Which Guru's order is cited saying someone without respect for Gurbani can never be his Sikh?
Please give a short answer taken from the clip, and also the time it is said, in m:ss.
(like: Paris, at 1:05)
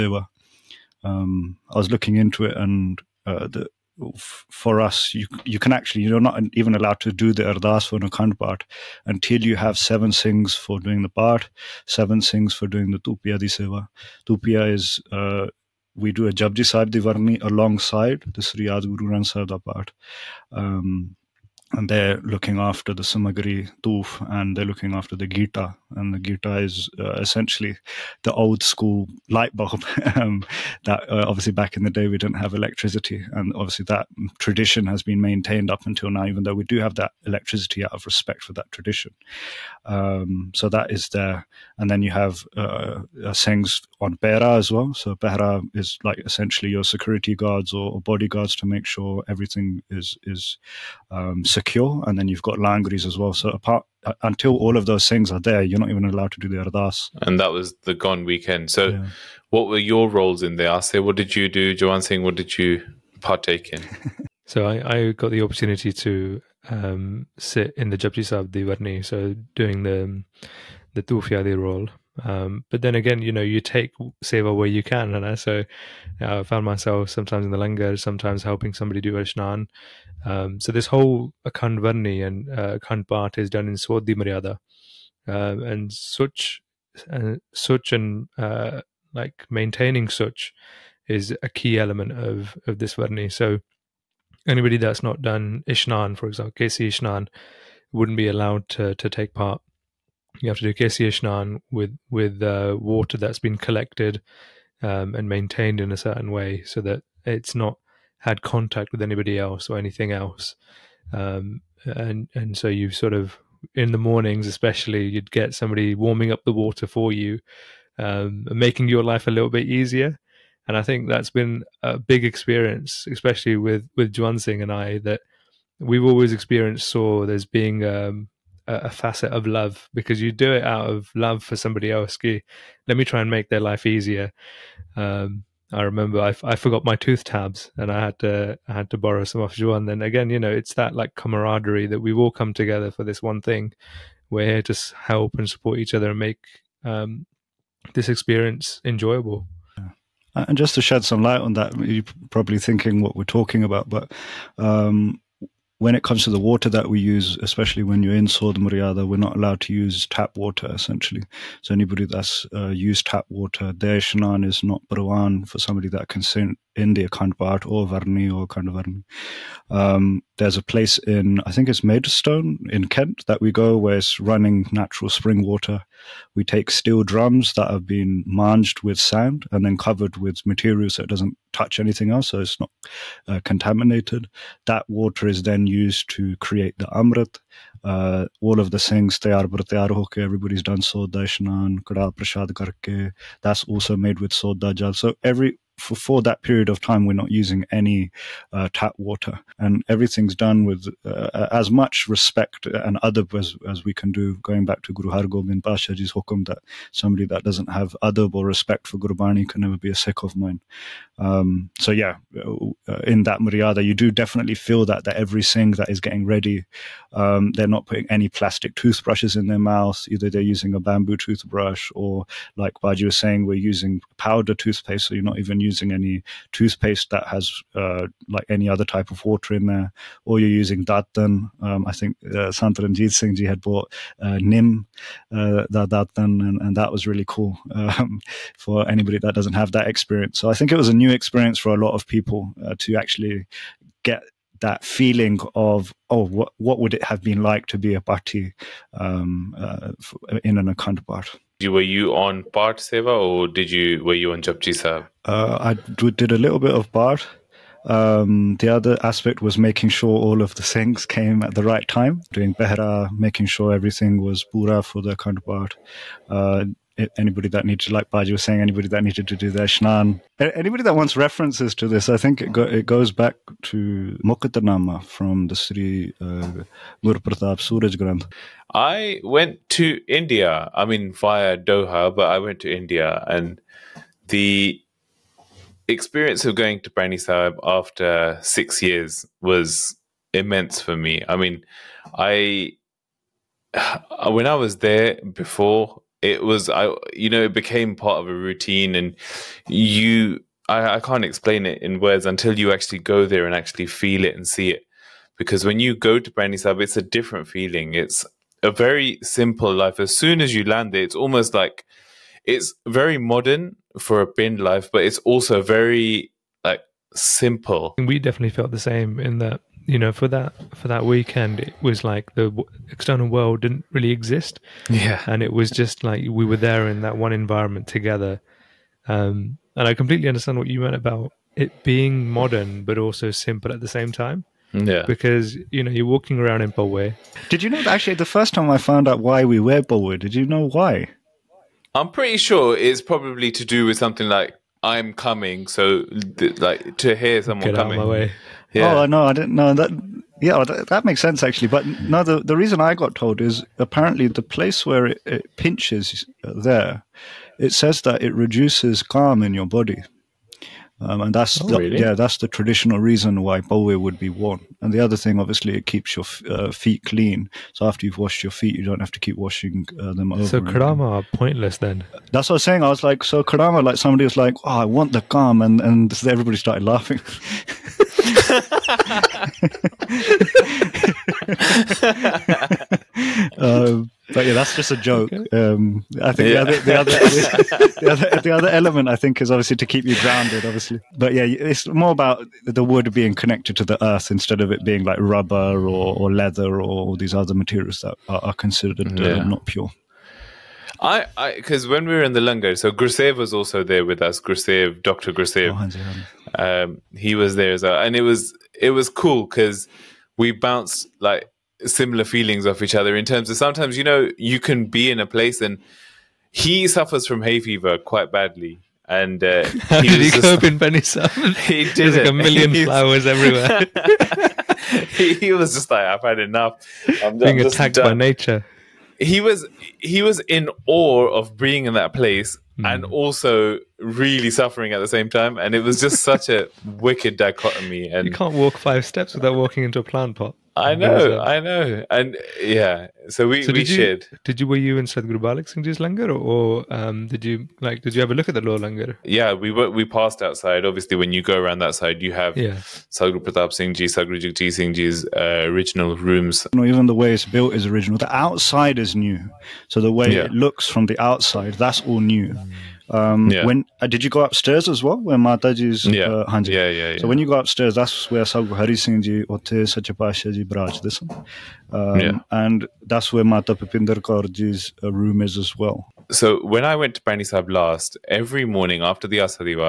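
Guru Har Gobind, at 3:24.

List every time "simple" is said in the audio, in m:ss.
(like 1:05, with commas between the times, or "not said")
5:09, 5:17, 5:33.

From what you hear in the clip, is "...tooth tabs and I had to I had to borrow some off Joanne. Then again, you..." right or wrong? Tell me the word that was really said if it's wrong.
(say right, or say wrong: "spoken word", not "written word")
wrong: "Juan", not "Joanne".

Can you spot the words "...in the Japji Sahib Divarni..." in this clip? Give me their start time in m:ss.
1:07.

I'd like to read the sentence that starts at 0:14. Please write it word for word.
is uh, we do a Japji Sahib Divarni alongside the Sri Ad Guru Granth Sahib part.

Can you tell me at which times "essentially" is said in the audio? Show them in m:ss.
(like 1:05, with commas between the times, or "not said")
0:27, 0:46, 2:40.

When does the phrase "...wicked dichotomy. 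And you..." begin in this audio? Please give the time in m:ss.
7:16.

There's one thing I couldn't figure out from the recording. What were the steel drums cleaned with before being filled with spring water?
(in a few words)
Sand.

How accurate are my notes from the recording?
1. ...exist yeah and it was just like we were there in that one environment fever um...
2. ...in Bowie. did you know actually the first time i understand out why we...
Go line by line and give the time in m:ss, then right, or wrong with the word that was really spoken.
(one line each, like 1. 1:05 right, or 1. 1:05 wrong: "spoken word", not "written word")
1. 5:24 wrong: "together", not "fever"
2. 5:36 wrong: "found", not "understand".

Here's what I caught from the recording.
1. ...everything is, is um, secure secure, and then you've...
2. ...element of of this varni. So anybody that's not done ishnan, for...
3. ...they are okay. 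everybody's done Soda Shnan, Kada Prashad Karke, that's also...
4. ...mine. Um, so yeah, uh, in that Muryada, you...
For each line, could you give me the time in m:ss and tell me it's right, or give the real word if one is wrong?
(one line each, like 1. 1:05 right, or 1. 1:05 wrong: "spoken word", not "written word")
1. 0:49 right
2. 1:31 right
3. 3:09 right
4. 3:30 right.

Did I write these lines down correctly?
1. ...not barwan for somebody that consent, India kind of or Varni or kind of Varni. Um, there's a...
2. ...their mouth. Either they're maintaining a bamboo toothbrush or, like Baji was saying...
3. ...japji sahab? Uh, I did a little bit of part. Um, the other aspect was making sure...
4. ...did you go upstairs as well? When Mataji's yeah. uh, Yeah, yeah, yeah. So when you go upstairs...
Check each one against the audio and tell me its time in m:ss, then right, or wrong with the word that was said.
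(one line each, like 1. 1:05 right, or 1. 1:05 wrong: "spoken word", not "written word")
1. 2:44 right
2. 3:39 wrong: "using", not "maintaining"
3. 4:14 right
4. 7:44 right.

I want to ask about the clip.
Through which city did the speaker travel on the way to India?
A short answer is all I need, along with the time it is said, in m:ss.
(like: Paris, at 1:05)
Doha, at 4:41.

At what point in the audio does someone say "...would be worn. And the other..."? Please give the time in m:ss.
6:03.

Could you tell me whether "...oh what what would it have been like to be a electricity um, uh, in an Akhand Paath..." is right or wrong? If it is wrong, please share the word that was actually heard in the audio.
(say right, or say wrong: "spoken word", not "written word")
wrong: "party", not "electricity".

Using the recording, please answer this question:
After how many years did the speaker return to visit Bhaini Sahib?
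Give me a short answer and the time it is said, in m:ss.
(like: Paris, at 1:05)
6, at 4:48.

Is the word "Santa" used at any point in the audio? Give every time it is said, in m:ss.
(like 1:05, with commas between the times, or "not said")
3:52.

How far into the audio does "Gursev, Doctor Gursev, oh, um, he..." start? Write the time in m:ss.
6:44.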